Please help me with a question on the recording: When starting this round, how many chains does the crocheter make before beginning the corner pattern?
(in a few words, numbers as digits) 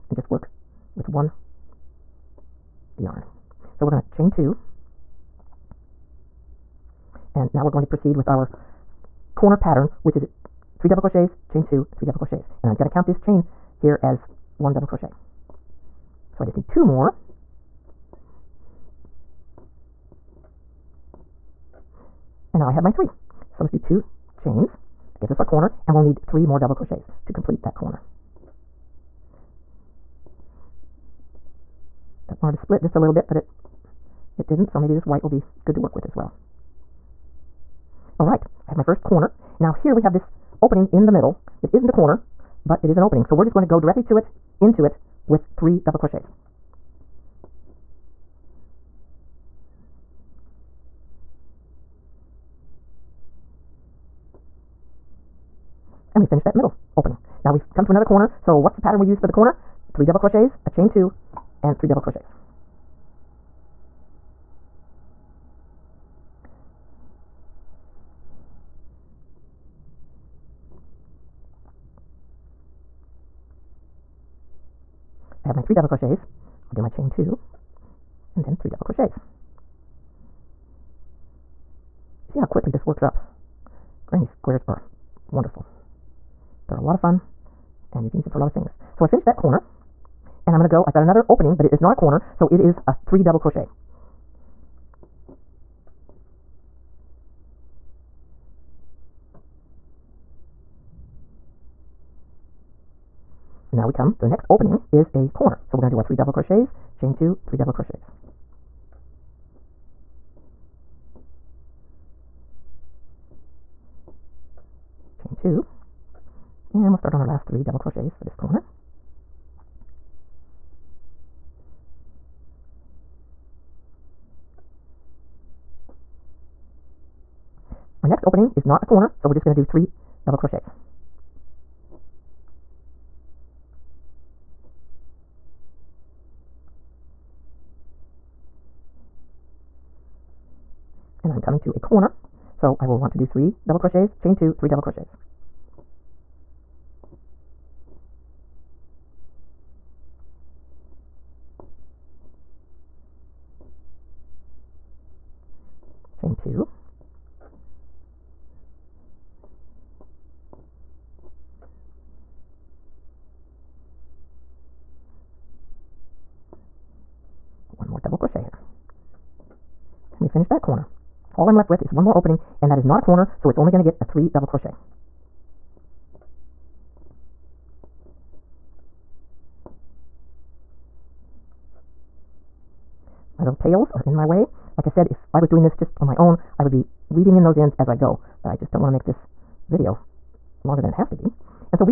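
2.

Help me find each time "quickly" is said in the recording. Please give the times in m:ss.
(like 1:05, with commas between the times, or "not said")
1:22.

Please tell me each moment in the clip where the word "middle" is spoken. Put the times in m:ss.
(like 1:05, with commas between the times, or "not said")
0:41, 0:56.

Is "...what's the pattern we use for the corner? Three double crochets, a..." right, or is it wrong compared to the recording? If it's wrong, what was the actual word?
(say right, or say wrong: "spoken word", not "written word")
right.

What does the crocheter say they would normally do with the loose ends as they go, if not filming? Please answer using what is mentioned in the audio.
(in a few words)
Weaving in those ends.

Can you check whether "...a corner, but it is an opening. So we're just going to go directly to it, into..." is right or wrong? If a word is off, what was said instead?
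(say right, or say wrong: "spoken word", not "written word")
right.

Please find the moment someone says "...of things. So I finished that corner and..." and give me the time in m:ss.
1:28.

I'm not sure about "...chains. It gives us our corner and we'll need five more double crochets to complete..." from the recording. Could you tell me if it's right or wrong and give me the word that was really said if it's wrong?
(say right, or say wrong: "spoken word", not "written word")
wrong: "three", not "five".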